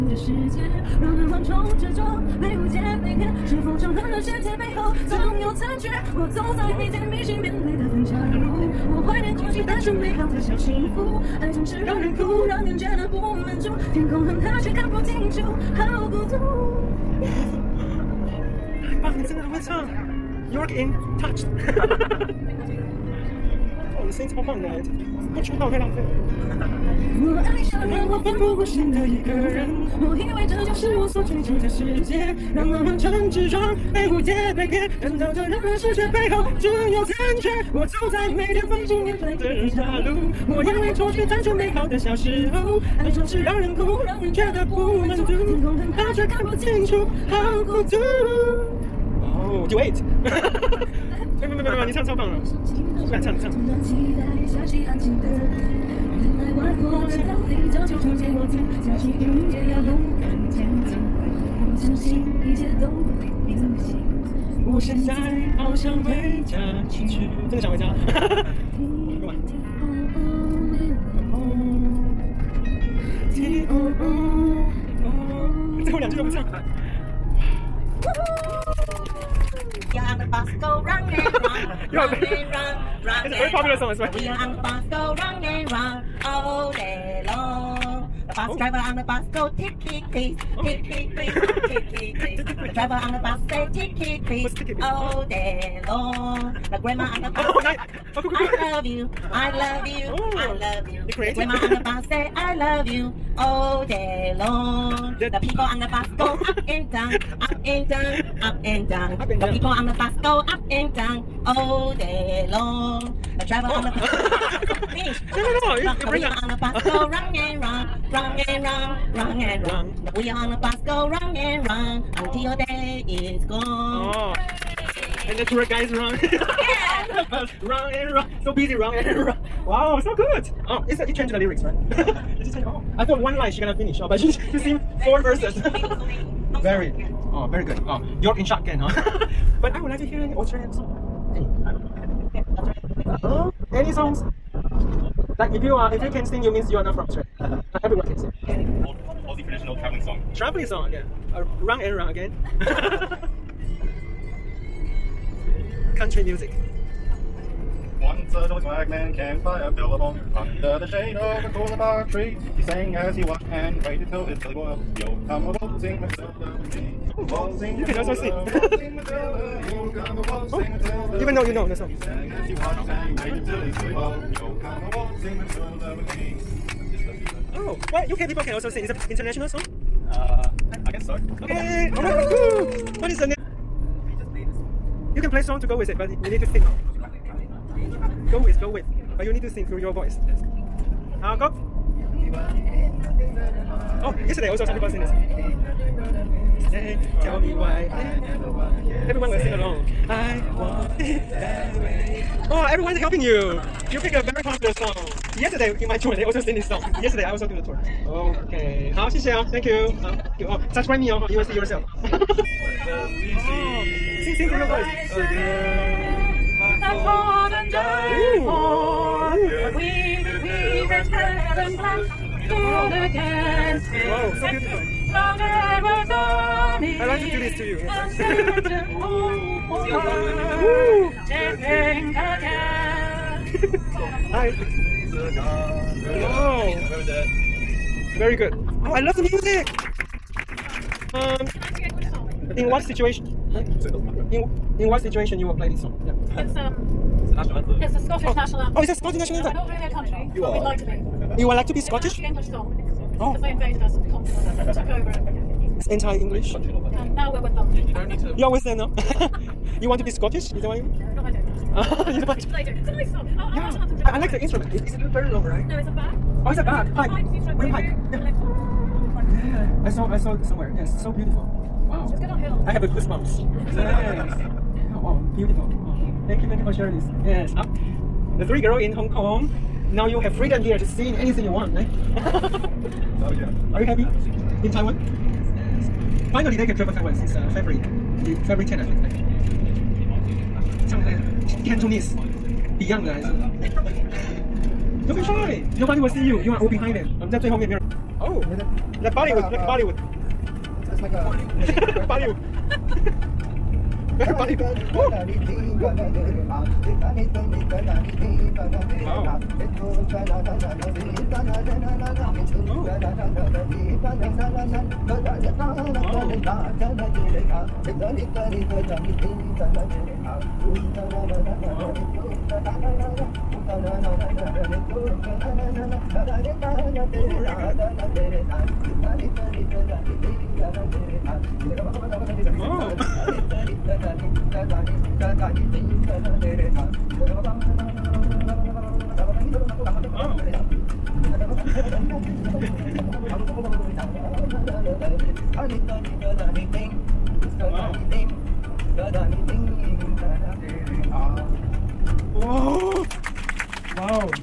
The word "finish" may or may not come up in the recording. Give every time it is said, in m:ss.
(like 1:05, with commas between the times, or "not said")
1:54, 2:13.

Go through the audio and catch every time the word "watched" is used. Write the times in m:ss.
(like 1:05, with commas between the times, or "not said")
2:43, 2:52.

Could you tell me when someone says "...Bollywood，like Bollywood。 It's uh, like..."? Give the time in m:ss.
4:59.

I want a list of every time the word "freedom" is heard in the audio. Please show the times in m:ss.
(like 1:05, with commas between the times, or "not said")
4:40.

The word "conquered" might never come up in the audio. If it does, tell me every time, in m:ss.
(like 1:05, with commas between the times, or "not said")
4:14.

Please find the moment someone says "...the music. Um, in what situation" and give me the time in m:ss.
3:59.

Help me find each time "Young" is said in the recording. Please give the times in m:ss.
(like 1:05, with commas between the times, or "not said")
1:19, 1:24.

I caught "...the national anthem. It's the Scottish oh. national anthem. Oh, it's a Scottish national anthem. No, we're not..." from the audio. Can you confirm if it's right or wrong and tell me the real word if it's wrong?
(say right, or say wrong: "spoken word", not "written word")
right.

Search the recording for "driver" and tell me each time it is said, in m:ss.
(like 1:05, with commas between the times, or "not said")
1:28, 1:32, 1:53.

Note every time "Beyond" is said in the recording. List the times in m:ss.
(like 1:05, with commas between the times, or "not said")
4:52.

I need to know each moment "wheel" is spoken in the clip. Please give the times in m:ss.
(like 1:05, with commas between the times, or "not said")
1:56, 2:00.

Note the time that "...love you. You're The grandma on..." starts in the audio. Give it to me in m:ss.
1:40.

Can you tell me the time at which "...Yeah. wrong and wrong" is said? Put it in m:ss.
2:06.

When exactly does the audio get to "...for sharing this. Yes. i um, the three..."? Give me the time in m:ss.
4:36.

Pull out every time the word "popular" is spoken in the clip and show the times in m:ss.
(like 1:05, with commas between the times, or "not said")
1:23, 3:24.